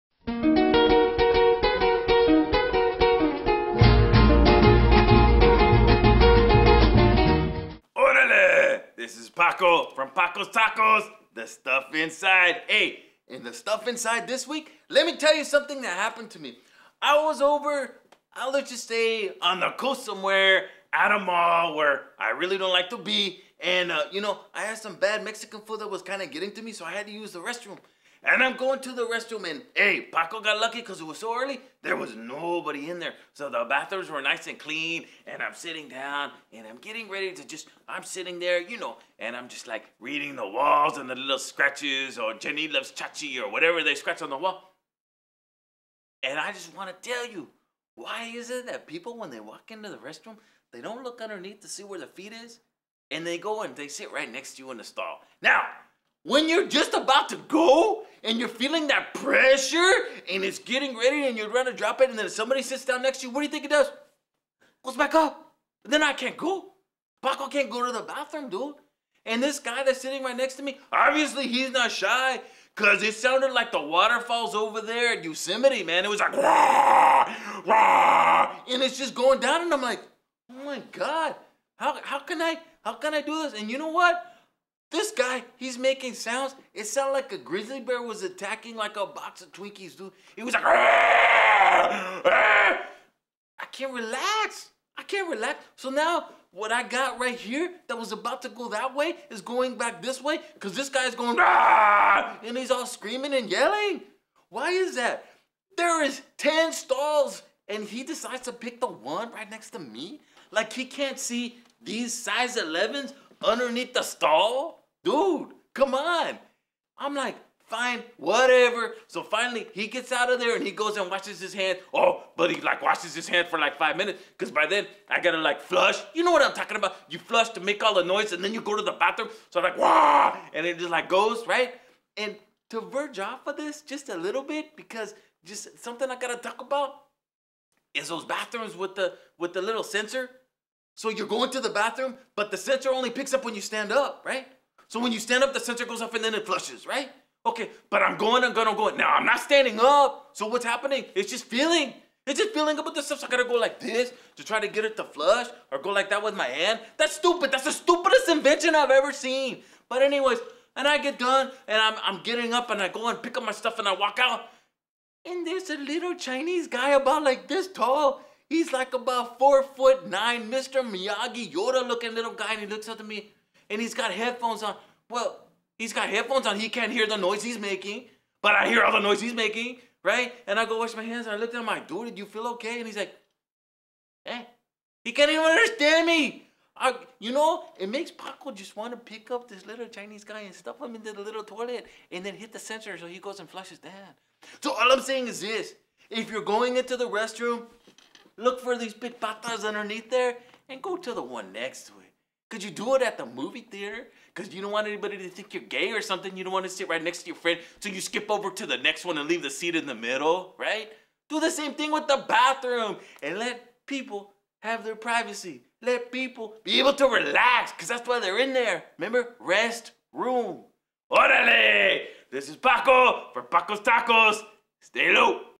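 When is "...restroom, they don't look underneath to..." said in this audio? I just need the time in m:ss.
0:49.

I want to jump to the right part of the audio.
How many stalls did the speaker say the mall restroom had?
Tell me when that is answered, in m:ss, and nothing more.
1:46.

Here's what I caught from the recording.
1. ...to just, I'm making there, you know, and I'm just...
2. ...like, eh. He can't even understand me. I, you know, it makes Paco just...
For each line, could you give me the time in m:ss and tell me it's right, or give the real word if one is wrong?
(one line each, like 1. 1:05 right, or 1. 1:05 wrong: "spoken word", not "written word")
1. 0:37 wrong: "sitting", not "making"
2. 3:02 right.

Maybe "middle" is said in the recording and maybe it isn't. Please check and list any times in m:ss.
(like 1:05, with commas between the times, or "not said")
3:29.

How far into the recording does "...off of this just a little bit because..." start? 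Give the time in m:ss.
2:13.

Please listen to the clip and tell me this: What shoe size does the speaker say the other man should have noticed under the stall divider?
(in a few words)
11.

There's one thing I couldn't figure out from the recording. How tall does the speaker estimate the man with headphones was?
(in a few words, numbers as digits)
4 foot 9.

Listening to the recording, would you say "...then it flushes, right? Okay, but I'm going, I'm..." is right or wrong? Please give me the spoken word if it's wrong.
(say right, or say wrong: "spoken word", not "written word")
right.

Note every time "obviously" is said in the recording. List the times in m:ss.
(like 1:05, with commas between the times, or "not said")
1:10.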